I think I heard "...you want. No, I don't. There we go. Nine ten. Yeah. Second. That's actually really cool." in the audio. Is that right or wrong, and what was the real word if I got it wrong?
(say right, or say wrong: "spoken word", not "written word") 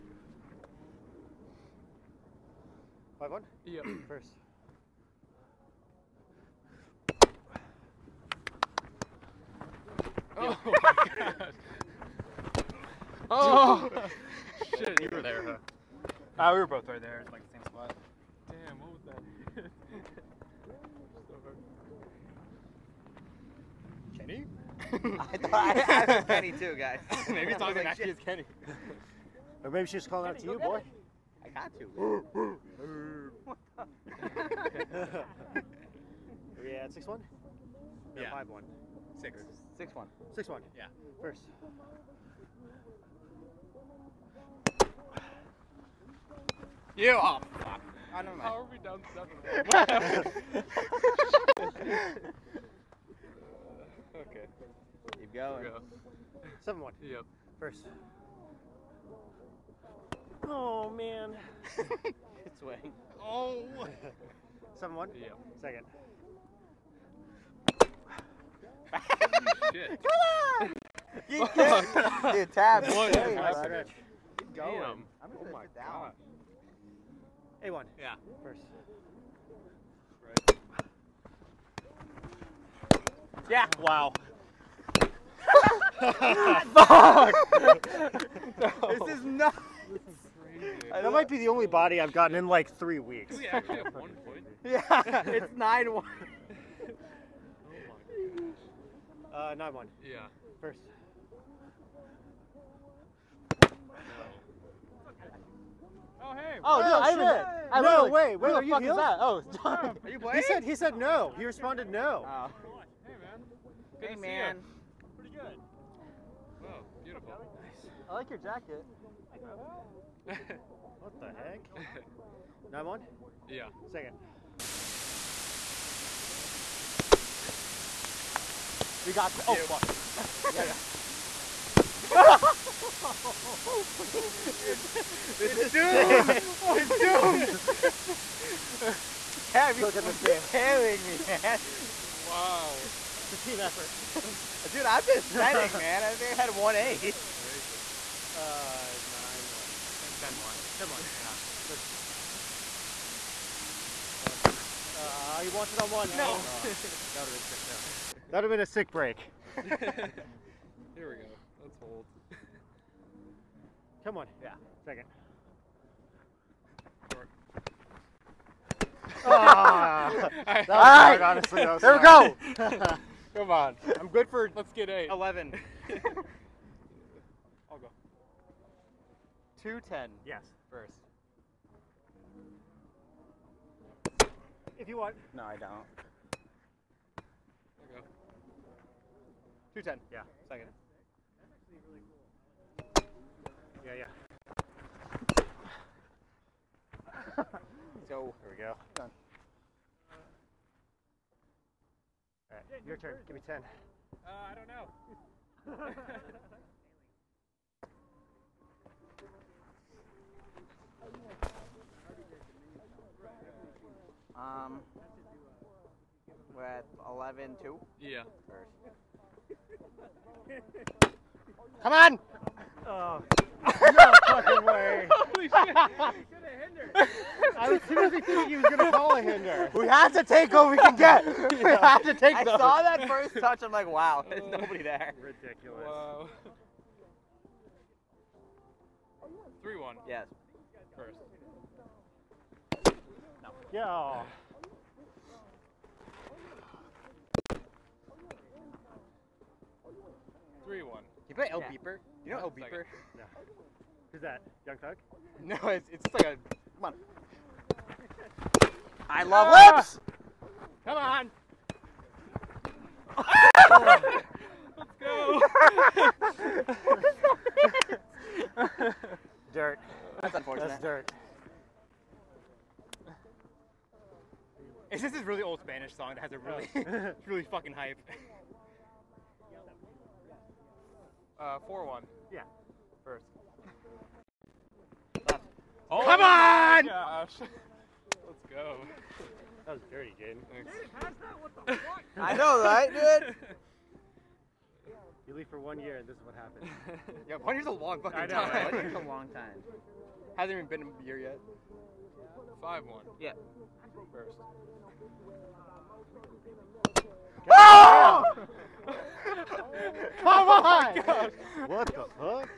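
wrong: "Two", not "Nine".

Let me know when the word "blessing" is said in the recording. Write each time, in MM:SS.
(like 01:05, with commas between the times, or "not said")
not said.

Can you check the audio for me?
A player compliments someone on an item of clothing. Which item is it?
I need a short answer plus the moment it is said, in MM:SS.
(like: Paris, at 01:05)
jacket, at 01:58.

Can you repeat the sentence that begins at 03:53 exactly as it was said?
I'm like, wow, there's oh, nobody there.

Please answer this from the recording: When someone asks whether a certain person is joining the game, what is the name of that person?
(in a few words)
John.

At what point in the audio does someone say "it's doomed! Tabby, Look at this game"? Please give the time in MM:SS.
02:16.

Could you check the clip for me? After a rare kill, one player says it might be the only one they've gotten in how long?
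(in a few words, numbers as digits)
three weeks.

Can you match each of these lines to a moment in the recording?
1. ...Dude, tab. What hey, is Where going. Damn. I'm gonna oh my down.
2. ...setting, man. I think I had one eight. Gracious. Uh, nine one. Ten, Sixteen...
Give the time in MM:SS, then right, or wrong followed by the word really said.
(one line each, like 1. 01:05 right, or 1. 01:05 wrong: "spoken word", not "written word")
1. 01:12 wrong: "Keep", not "Where"
2. 02:25 wrong: "Ten", not "Sixteen".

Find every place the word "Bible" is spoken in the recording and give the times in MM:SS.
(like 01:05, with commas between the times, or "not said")
not said.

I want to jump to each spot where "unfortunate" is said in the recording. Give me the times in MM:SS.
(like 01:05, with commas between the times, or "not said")
04:30.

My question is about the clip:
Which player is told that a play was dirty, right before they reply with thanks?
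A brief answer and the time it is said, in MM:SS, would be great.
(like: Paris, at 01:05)
Jaden, at 04:50.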